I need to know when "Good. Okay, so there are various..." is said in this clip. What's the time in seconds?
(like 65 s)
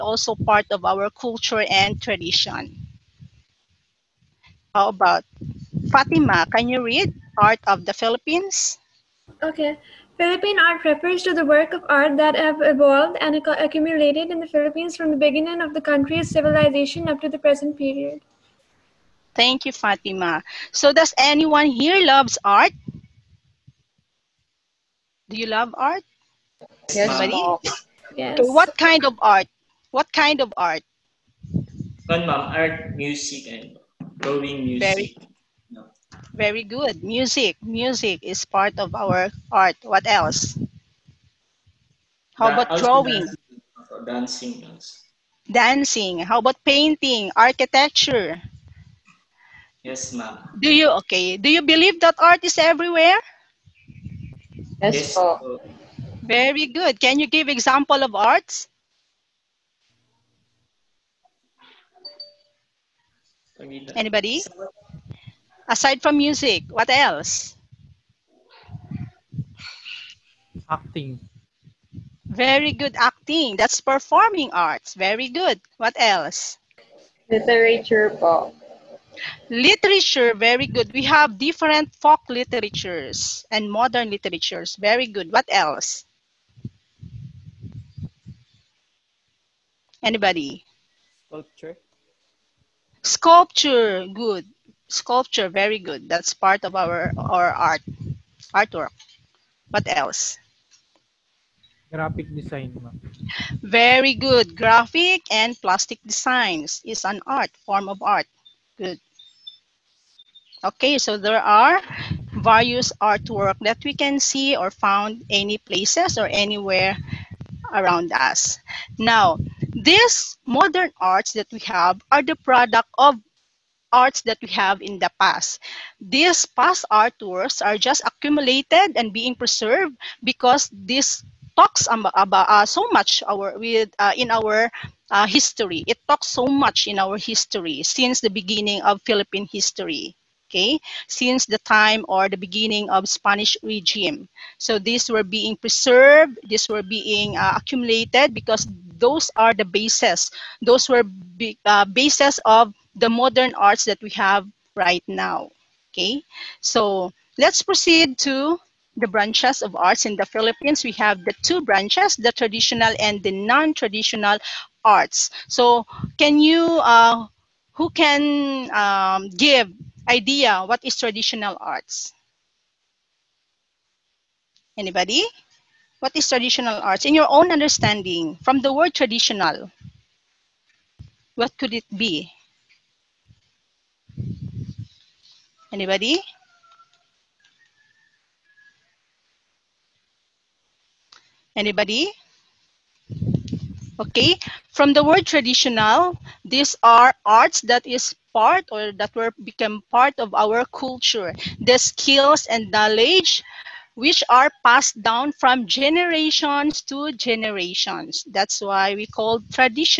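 108 s.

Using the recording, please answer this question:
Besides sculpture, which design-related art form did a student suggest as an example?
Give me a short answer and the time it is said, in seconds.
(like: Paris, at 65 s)
Graphic design, at 101 s.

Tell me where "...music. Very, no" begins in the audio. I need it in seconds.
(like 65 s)
34 s.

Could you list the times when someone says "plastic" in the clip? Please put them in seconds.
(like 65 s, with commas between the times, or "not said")
105 s.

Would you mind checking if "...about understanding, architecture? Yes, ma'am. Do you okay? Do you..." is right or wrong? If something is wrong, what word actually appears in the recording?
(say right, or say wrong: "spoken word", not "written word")
wrong: "painting", not "understanding".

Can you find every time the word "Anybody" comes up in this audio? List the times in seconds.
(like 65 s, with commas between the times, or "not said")
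63 s, 90 s, 174 s, 185 s, 191 s.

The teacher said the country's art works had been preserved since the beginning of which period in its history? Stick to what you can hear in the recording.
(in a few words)
Spanish regime.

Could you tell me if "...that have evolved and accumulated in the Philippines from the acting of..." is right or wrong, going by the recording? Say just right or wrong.
wrong.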